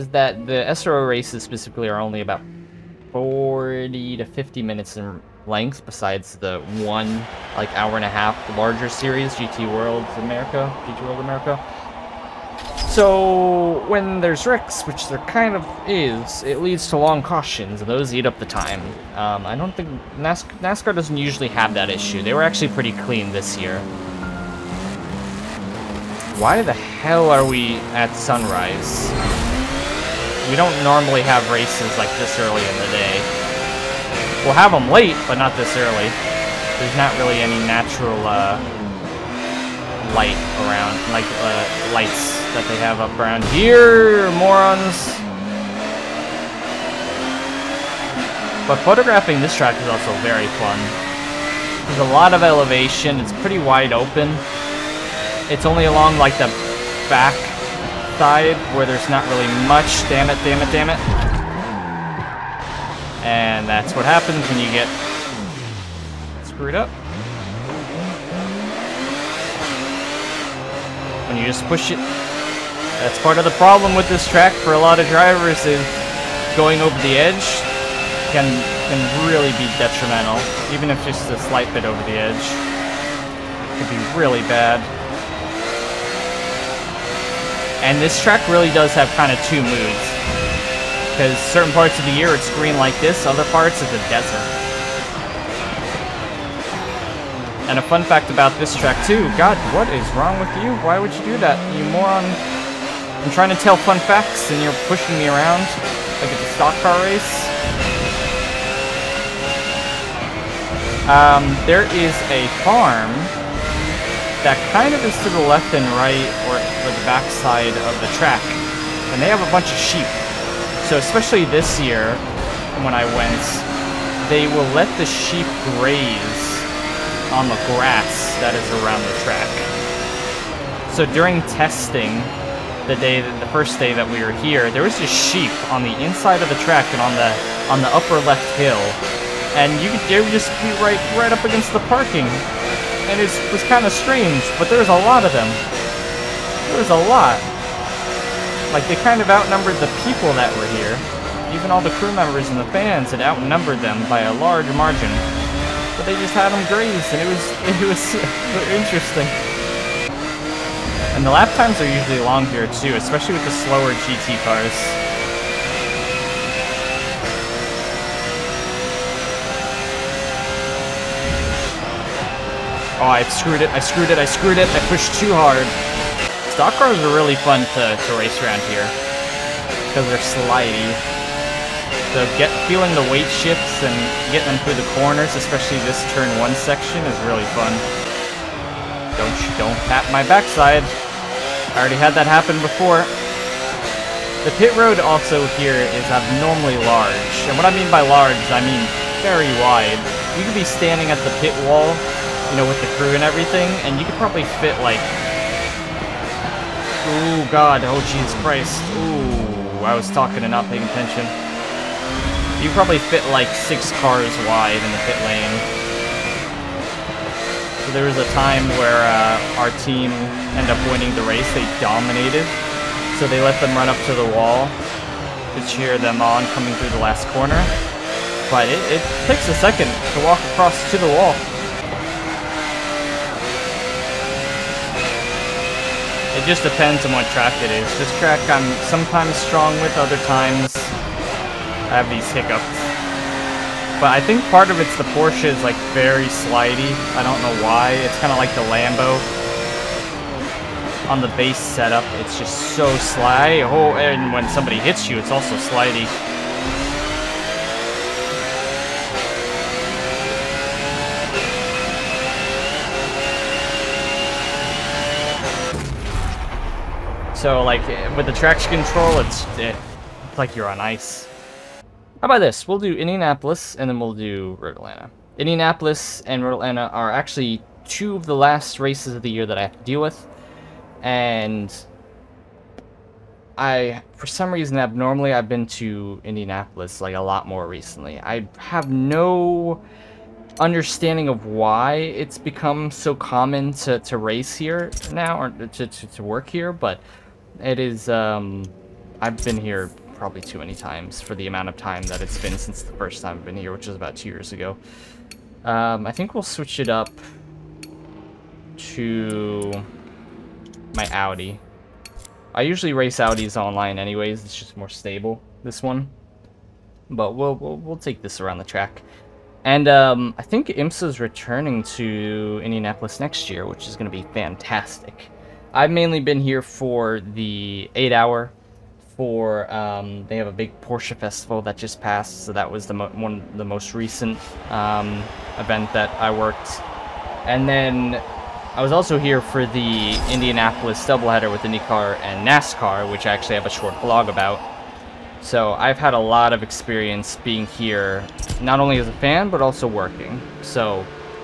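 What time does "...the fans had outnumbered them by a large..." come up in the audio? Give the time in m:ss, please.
2:32.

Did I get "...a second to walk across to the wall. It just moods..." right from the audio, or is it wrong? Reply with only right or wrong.
wrong.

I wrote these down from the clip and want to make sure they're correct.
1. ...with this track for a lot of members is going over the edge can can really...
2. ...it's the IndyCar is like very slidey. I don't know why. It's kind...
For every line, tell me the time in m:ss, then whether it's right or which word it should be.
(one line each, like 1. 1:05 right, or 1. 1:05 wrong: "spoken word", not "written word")
1. 1:13 wrong: "drivers", not "members"
2. 4:04 wrong: "Porsche", not "IndyCar".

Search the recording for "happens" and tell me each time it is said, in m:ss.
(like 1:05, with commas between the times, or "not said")
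1:04, 3:12.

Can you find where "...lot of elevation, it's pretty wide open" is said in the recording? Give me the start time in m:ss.
0:52.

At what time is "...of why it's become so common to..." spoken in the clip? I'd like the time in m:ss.
4:51.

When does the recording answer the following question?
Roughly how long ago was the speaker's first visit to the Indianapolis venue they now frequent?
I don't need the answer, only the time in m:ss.
5:04.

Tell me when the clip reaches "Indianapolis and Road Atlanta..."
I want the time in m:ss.
4:35.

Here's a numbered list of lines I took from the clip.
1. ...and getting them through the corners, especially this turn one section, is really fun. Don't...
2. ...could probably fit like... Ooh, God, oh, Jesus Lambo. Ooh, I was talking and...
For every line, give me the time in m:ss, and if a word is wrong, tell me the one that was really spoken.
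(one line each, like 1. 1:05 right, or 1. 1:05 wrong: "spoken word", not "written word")
1. 3:03 right
2. 3:24 wrong: "Christ", not "Lambo".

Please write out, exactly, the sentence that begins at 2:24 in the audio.
But there was a lot of them.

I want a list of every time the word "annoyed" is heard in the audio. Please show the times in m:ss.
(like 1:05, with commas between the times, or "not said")
not said.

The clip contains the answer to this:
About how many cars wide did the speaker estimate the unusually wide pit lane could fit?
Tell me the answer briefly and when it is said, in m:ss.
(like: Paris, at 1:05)
6, at 3:33.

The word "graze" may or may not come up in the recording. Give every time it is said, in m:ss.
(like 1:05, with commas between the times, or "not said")
2:05, 2:36.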